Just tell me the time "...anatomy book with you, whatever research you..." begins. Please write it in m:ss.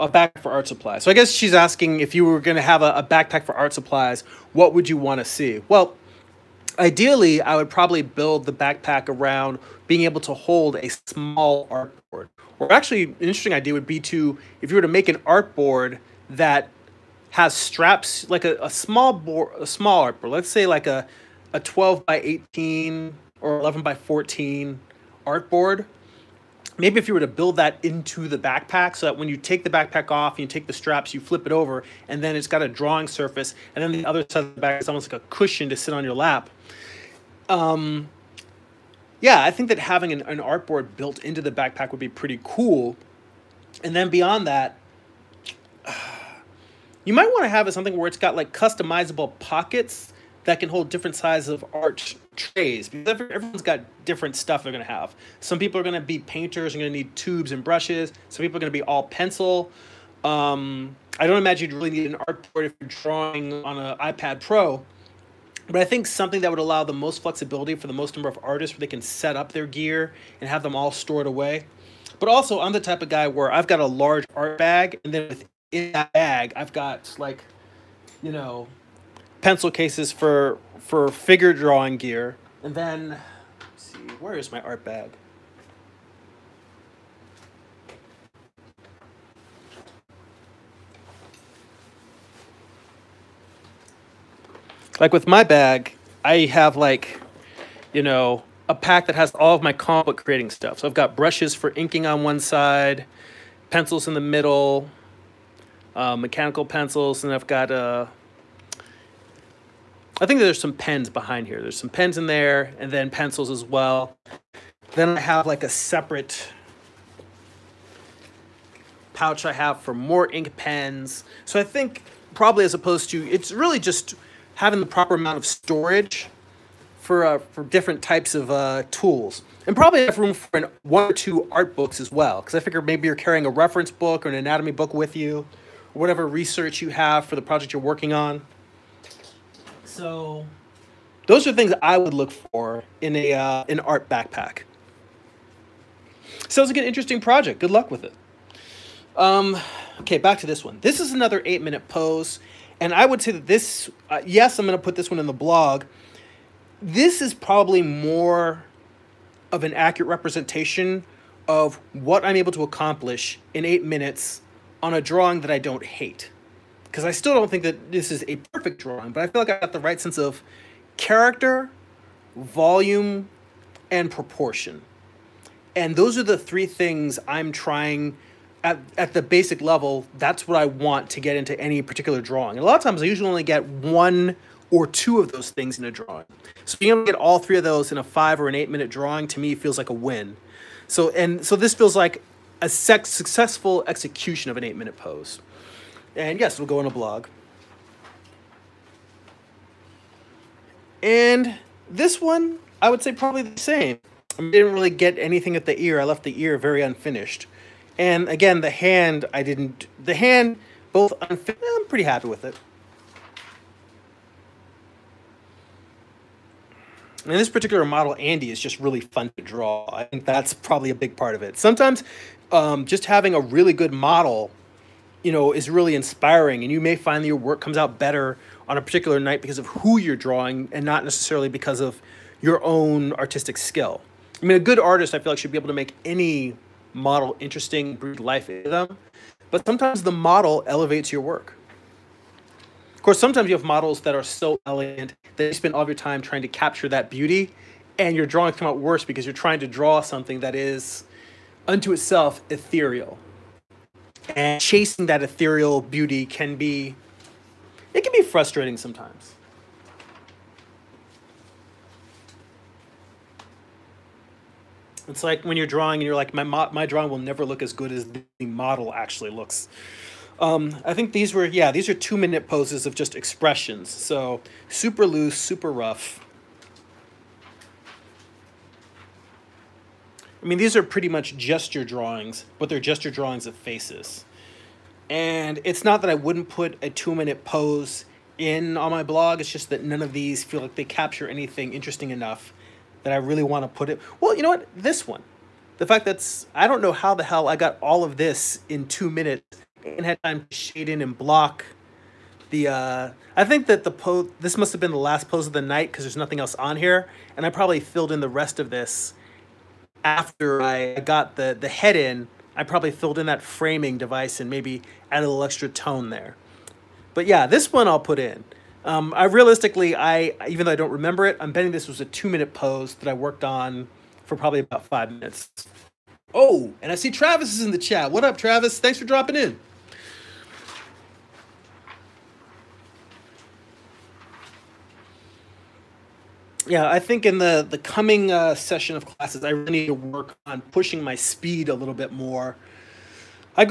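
2:14.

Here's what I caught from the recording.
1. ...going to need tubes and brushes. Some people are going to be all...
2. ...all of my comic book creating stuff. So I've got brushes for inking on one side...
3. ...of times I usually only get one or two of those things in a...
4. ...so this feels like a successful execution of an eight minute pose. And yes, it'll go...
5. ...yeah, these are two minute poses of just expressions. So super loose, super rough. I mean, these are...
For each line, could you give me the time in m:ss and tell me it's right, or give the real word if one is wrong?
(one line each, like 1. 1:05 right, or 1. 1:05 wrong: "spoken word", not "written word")
1. 0:56 right
2. 1:39 right
3. 3:02 right
4. 3:11 right
5. 4:31 right.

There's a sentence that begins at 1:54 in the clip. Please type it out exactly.
Then I have like a separate pouch I have for more ink pens.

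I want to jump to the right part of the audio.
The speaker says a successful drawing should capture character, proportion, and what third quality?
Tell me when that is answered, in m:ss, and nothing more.
2:52.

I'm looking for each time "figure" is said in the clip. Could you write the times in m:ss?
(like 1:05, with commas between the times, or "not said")
1:21, 2:12.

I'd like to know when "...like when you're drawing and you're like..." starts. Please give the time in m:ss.
4:25.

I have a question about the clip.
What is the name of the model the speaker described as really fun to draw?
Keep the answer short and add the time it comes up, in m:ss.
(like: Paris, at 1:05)
Andy, at 3:38.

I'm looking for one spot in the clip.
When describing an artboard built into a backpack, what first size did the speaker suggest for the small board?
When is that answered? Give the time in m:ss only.
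0:21.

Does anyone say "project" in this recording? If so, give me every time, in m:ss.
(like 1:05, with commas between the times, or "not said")
2:17, 2:27.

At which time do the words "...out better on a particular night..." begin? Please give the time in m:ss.
3:47.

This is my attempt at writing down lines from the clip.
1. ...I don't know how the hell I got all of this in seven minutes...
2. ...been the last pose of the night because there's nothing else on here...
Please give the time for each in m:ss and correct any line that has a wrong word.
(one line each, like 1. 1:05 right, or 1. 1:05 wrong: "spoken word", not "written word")
1. 4:56 wrong: "two", not "seven"
2. 5:04 right.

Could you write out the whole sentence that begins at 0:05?
Well, ideally, I would probably build the backpack around being able to hold a small artboard.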